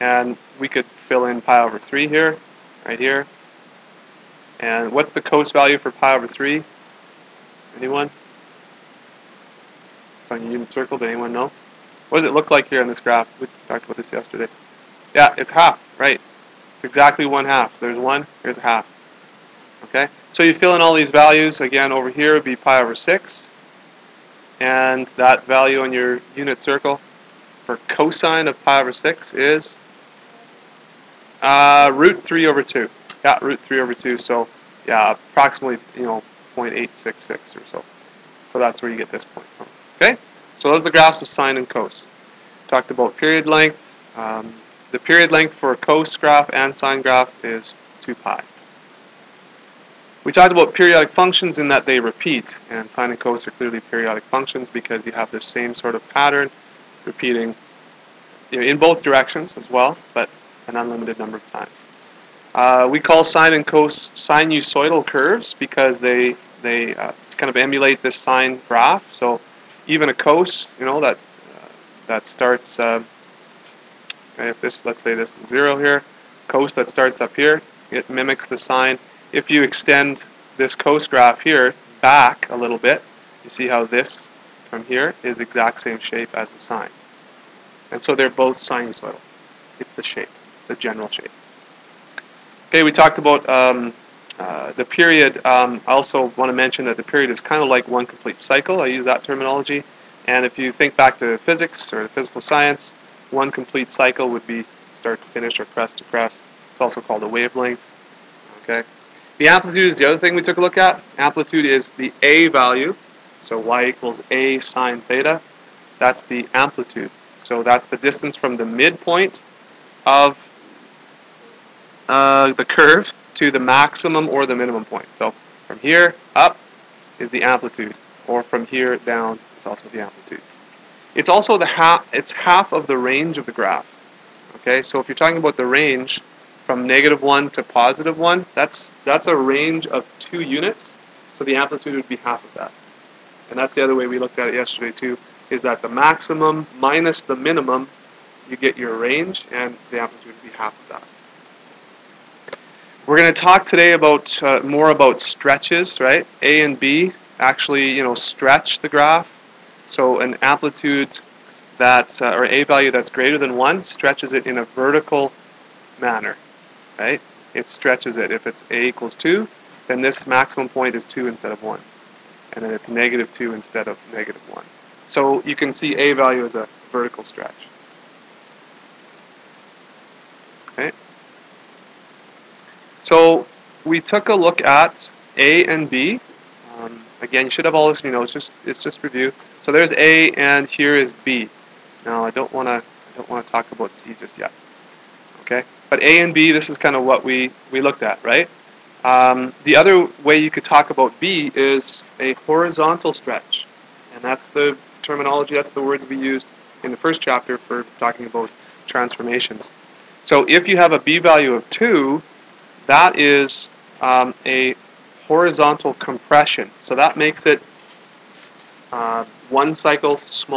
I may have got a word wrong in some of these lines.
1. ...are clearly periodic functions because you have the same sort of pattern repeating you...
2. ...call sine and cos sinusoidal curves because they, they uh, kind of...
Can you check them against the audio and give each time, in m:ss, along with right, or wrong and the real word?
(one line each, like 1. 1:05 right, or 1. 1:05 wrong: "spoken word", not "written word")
1. 0:53 right
2. 1:02 right.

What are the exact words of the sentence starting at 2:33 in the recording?
We're going to talk today about uh, more about stretches, right?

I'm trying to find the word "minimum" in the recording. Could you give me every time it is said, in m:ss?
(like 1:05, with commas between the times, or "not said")
2:04, 2:27.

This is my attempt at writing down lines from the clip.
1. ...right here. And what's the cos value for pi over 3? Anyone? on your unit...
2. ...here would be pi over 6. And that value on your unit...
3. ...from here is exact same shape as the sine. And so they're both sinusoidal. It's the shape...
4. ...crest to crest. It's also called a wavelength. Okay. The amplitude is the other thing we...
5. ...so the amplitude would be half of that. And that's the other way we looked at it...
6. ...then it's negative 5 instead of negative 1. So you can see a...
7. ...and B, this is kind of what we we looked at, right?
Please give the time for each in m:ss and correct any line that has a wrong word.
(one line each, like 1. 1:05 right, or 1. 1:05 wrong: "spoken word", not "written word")
1. 0:02 right
2. 0:22 right
3. 1:24 right
4. 1:45 right
5. 2:21 right
6. 2:52 wrong: "2", not "5"
7. 3:16 right.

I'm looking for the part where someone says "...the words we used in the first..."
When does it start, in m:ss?
3:25.